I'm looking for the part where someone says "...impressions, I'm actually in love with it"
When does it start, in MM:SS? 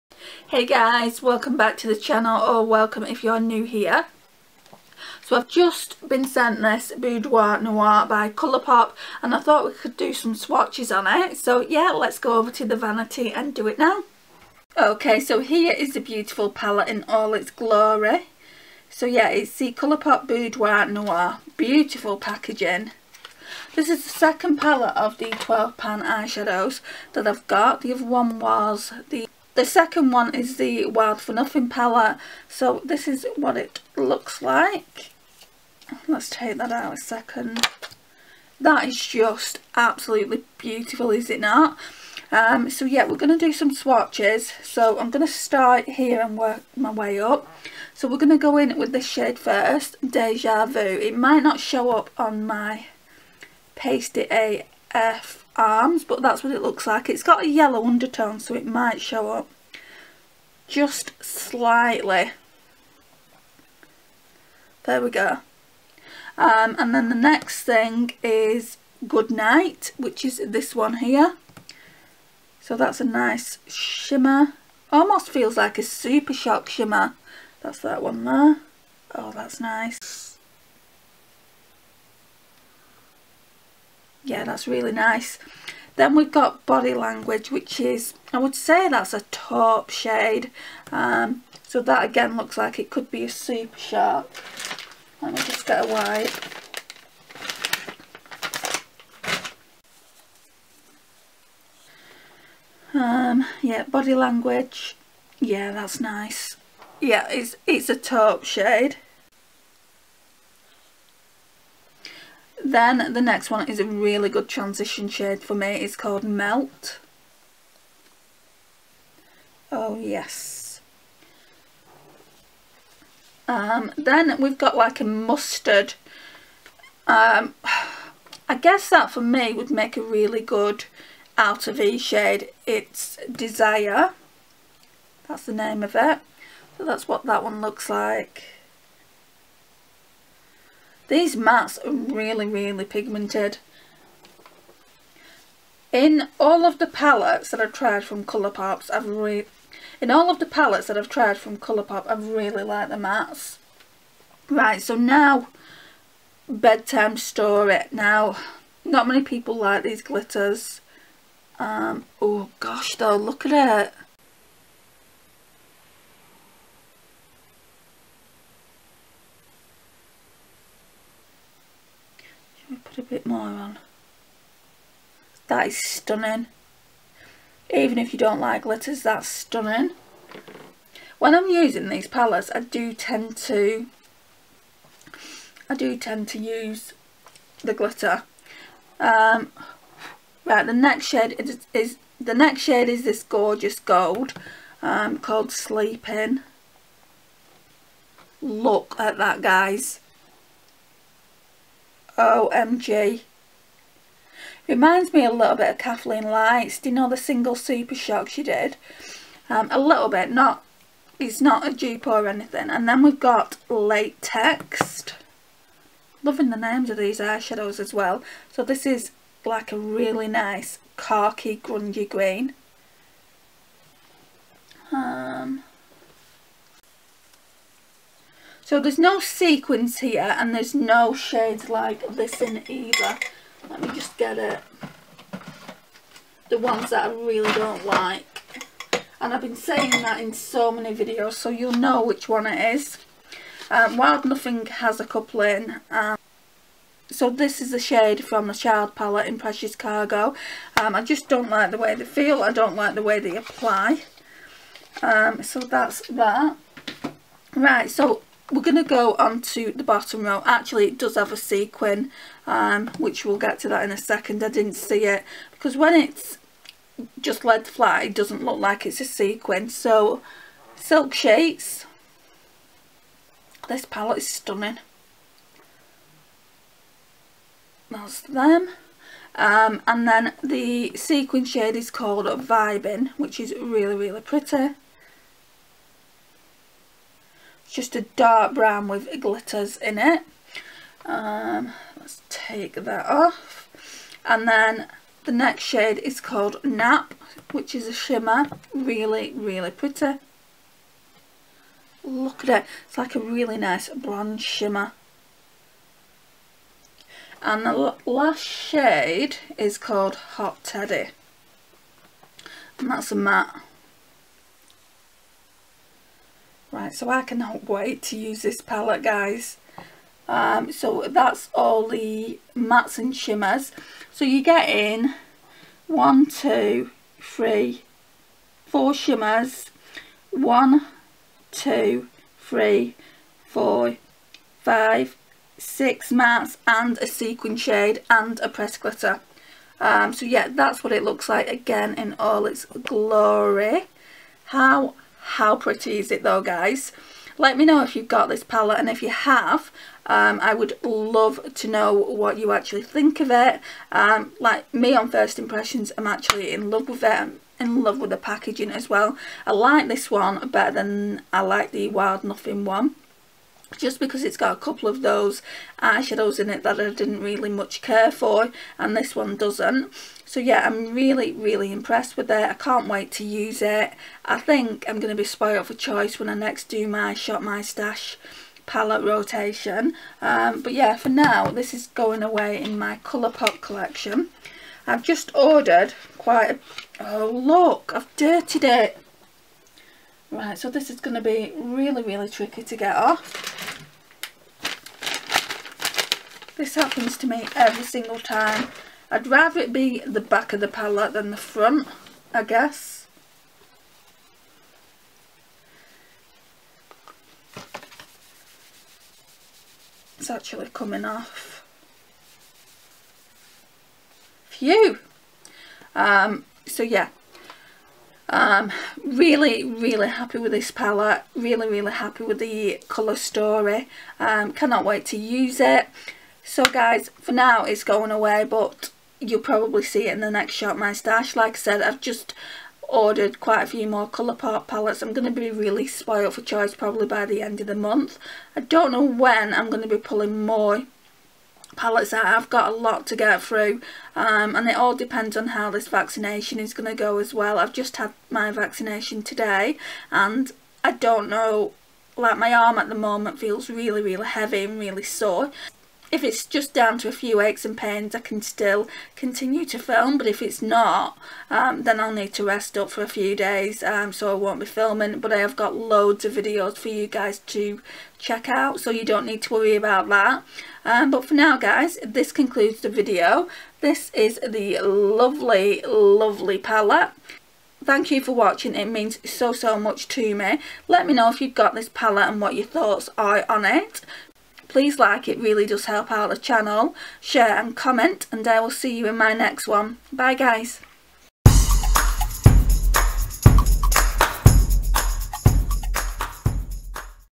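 05:55.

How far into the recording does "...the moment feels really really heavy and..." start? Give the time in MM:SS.
07:32.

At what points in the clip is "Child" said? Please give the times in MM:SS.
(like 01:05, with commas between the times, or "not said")
04:08.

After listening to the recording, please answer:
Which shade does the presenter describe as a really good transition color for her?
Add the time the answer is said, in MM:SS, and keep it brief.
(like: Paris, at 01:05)
Melt, at 01:56.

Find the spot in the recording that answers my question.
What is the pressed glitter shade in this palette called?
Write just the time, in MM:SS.
02:36.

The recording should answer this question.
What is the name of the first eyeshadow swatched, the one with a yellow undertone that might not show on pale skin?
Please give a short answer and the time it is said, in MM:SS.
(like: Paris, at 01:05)
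Deja Vu, at 00:50.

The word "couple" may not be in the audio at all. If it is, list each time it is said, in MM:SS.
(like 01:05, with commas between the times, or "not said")
04:05, 06:04.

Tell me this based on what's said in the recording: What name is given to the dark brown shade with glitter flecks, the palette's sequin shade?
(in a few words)
Vibin.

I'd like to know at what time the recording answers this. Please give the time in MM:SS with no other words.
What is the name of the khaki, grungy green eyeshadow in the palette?
03:33.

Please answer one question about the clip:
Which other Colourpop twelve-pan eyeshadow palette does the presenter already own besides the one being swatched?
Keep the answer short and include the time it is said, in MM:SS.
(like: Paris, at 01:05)
Wild for Nothing, at 00:30.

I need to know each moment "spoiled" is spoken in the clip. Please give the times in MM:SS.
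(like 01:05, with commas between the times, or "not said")
06:15, 07:15.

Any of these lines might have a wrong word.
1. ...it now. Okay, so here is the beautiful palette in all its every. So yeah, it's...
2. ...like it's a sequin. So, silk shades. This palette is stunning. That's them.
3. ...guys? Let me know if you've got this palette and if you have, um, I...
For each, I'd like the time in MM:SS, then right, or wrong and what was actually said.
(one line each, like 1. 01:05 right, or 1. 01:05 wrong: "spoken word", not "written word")
1. 00:13 wrong: "glory", not "every"
2. 04:28 right
3. 05:46 right.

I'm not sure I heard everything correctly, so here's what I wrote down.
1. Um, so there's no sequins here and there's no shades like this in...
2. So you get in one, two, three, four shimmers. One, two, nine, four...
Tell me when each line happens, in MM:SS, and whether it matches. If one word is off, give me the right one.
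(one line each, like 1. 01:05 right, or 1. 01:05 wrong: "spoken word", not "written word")
1. 03:44 right
2. 05:24 wrong: "three", not "nine".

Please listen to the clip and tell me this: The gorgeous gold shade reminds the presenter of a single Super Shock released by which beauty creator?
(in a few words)
Kathleen Lights.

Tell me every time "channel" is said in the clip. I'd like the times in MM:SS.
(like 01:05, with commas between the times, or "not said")
00:01, 08:06.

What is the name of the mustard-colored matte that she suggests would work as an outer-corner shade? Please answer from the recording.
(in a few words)
Desire.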